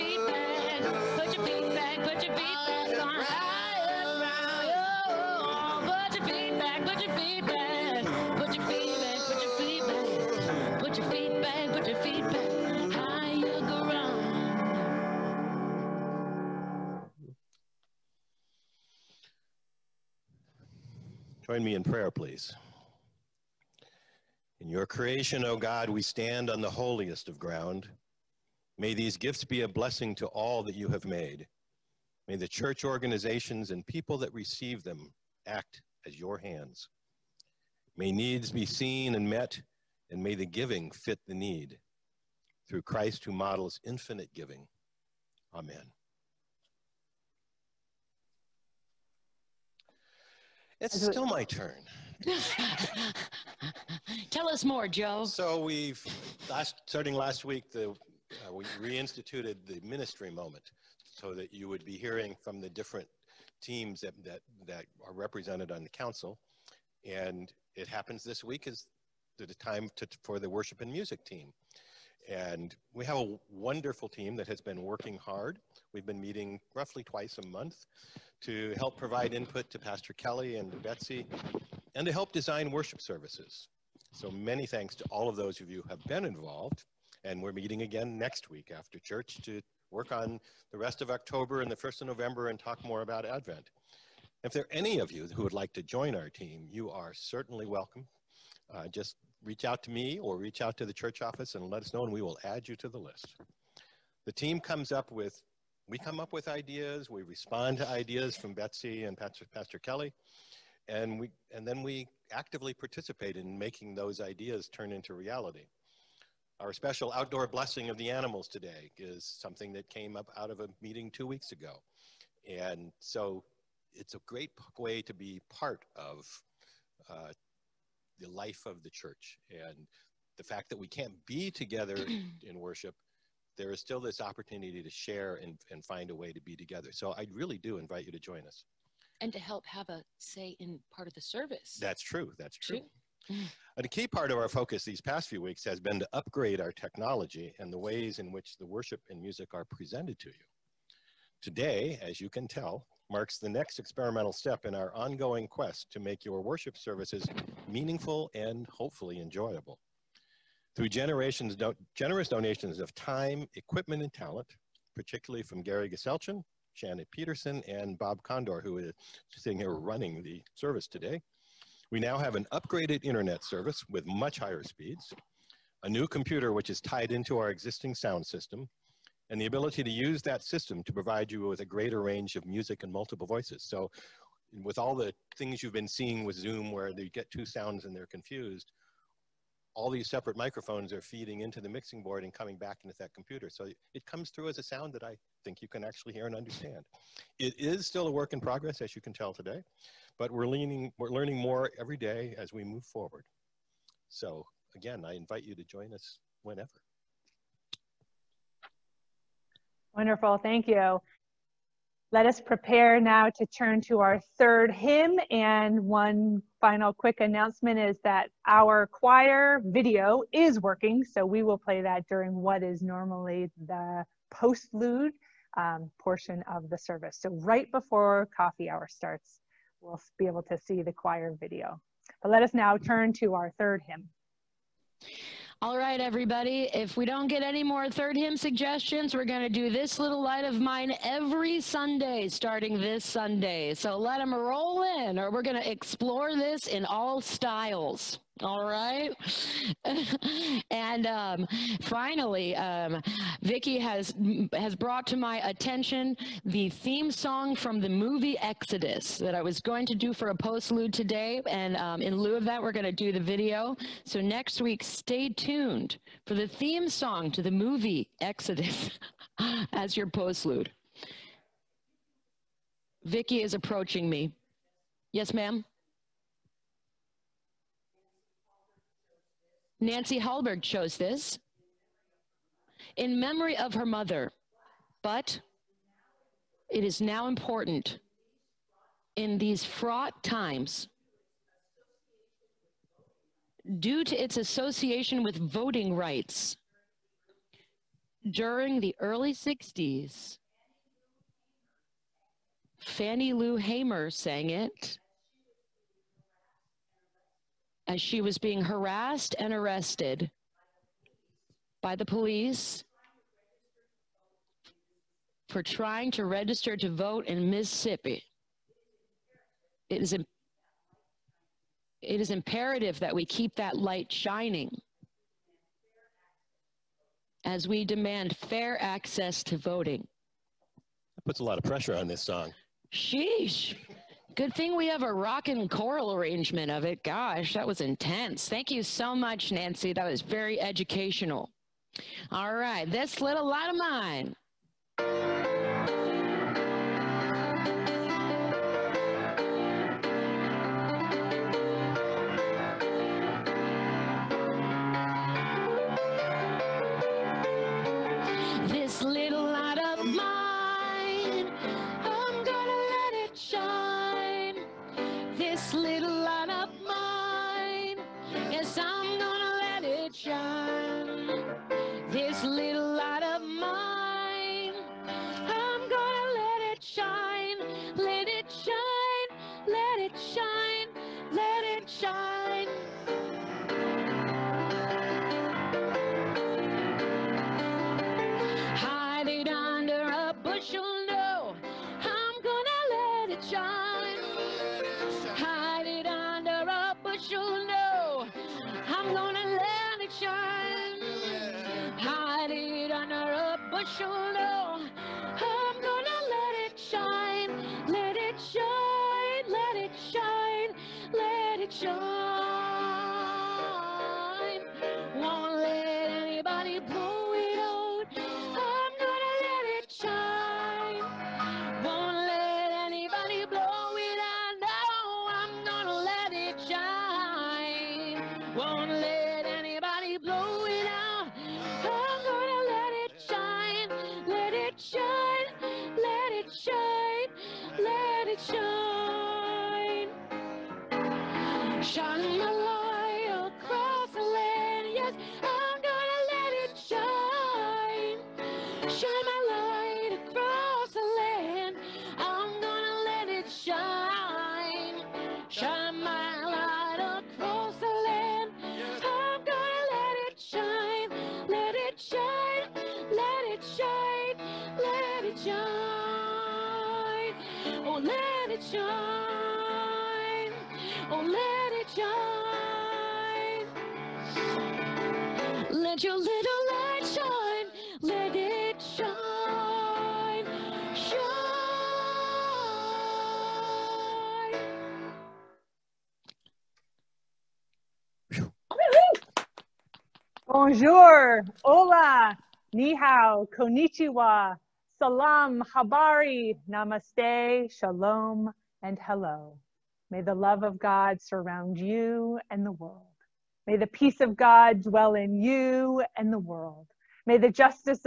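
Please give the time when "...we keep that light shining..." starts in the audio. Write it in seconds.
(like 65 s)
323 s.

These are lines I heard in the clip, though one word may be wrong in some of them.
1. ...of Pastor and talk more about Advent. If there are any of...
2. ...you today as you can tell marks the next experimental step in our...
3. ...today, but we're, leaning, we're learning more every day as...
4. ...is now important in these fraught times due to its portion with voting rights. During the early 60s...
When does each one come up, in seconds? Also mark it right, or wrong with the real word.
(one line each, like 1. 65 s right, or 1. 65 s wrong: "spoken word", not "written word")
1. 92 s wrong: "November", not "Pastor"
2. 150 s right
3. 199 s right
4. 286 s wrong: "association", not "portion".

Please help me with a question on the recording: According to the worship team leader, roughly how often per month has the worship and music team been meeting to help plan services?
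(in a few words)
twice a month.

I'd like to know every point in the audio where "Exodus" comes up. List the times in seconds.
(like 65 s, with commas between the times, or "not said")
258 s, 268 s.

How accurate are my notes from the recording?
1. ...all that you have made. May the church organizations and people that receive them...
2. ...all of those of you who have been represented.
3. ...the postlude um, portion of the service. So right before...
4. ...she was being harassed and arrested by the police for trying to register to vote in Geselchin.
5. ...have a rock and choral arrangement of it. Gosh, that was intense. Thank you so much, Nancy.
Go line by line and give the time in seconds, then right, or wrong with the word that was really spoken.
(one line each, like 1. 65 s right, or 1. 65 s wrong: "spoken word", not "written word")
1. 30 s right
2. 85 s wrong: "involved", not "represented"
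3. 223 s right
4. 308 s wrong: "Mississippi", not "Geselchin"
5. 334 s right.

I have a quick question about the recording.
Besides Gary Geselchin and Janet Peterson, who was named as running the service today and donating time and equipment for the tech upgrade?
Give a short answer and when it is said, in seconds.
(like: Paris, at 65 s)
Bob Condor, at 167 s.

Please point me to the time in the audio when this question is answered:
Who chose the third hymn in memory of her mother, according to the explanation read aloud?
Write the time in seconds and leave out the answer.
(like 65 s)
279 s.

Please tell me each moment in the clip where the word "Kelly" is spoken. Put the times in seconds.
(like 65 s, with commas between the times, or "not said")
80 s, 109 s.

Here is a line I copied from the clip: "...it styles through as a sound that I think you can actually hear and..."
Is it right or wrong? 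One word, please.
wrong.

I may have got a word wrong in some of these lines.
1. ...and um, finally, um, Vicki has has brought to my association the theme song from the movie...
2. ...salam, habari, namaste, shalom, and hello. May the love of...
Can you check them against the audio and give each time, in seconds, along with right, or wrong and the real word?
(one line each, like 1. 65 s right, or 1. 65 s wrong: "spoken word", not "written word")
1. 250 s wrong: "attention", not "association"
2. 494 s right.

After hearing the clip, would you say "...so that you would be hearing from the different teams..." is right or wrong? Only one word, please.
right.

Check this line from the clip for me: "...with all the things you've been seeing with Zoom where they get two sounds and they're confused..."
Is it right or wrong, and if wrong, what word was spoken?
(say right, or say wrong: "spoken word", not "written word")
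right.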